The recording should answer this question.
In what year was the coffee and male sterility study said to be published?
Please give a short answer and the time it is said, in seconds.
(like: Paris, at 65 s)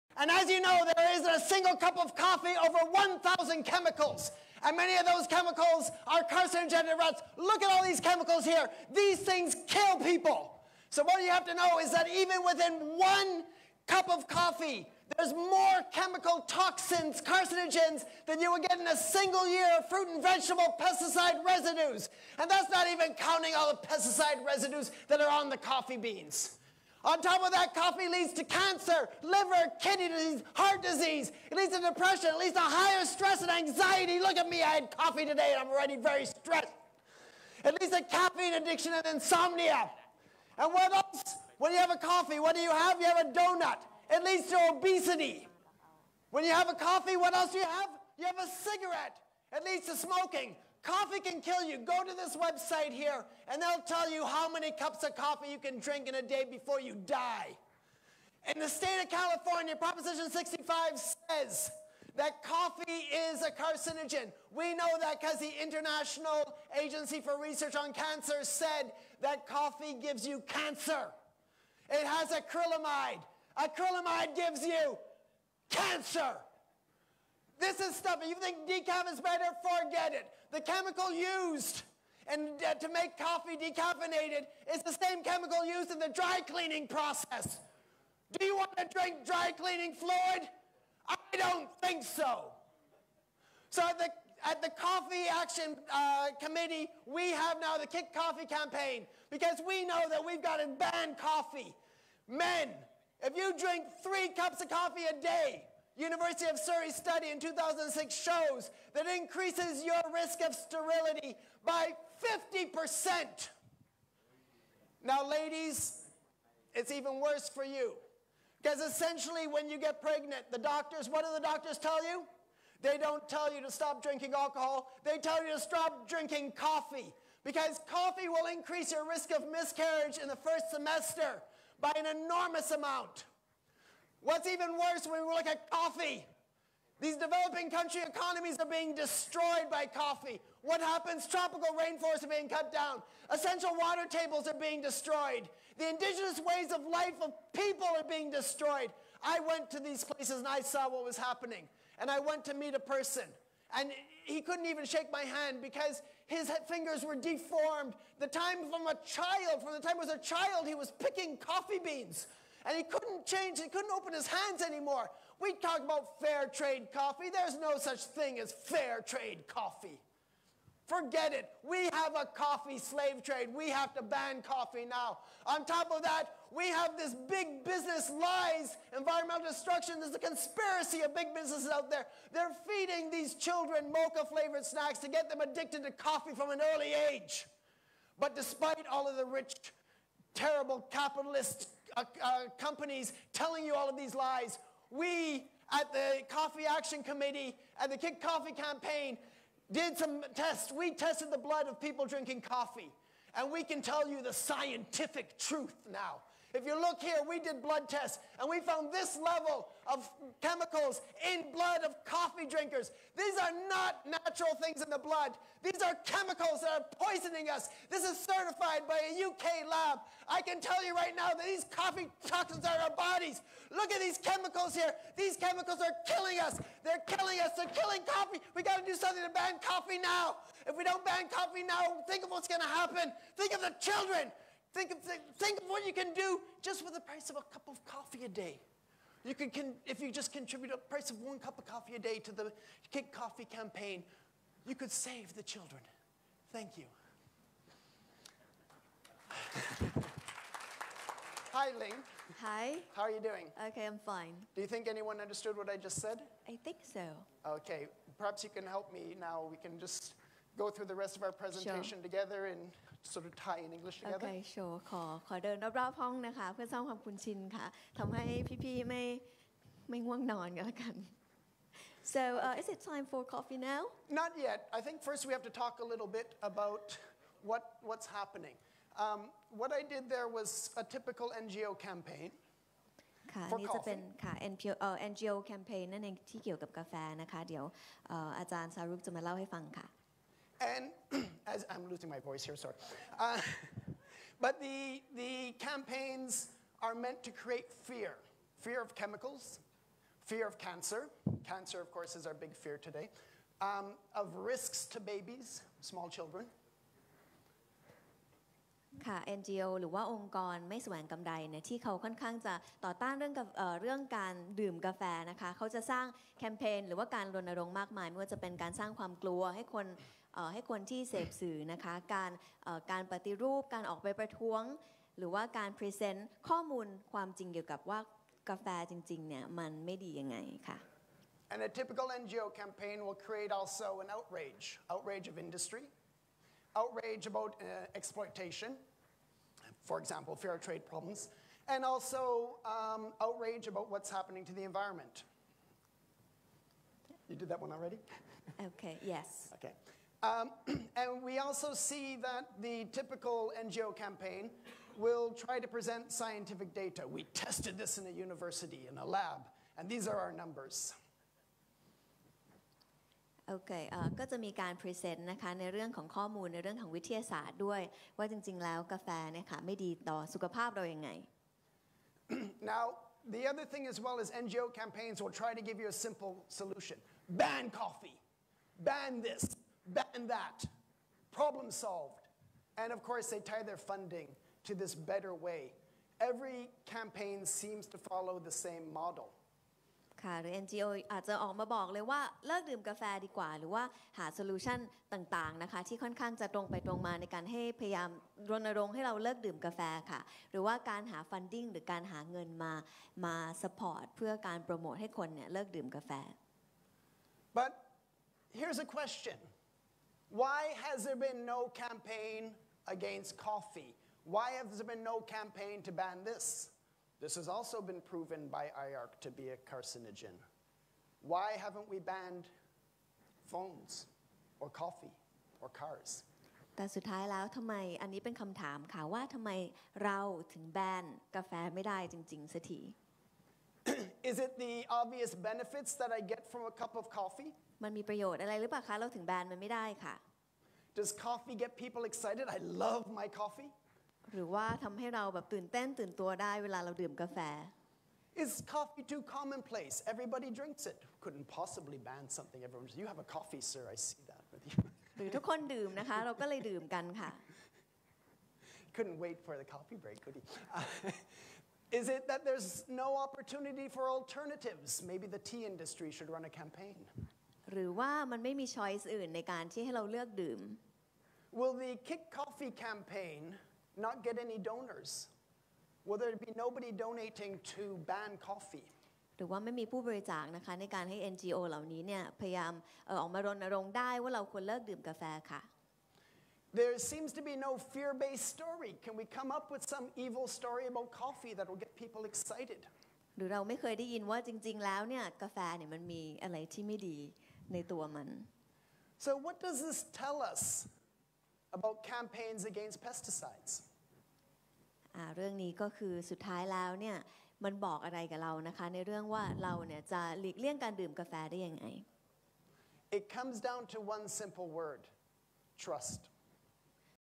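2006, at 107 s.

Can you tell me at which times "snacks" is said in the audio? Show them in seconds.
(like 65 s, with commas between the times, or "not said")
184 s.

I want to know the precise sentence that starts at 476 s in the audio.
Will there be nobody donating to ban coffee?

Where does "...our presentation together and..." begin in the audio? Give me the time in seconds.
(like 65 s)
261 s.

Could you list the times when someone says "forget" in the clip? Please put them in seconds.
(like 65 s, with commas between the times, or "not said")
79 s, 170 s.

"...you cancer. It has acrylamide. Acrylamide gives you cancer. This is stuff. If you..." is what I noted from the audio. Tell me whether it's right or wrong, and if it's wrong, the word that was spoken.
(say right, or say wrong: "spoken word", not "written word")
right.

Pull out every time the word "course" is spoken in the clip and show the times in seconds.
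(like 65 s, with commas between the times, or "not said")
301 s, 383 s.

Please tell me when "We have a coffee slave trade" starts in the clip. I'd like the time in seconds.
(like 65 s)
171 s.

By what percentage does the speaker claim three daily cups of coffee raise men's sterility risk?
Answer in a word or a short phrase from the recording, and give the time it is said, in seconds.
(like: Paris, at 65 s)
50%, at 112 s.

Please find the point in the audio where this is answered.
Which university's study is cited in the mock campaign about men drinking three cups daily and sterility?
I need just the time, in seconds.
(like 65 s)
106 s.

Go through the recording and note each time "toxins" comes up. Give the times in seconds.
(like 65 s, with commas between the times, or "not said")
16 s, 222 s.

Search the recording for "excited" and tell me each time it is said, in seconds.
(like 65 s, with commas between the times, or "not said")
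442 s, 492 s.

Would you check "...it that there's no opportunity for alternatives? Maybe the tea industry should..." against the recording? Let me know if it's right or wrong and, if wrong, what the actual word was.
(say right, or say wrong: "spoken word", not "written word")
right.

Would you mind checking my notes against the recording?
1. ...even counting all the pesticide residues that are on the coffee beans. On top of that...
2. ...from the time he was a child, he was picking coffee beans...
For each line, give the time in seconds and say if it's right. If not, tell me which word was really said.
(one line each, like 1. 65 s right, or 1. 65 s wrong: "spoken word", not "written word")
1. 22 s right
2. 159 s right.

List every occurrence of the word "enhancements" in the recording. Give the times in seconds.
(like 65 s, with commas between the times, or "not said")
not said.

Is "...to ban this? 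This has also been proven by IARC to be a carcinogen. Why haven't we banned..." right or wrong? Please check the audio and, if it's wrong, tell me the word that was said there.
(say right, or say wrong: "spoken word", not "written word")
right.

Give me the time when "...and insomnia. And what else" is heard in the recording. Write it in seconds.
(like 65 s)
38 s.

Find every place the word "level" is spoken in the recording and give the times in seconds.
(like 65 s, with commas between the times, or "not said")
209 s.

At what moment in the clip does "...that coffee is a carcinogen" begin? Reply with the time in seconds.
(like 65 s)
62 s.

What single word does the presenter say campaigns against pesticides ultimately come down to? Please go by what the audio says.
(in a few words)
Trust.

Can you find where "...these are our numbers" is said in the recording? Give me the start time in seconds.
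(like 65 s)
359 s.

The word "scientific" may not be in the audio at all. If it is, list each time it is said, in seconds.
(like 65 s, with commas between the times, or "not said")
204 s, 356 s.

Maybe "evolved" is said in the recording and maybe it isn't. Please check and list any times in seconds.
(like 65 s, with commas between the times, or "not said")
not said.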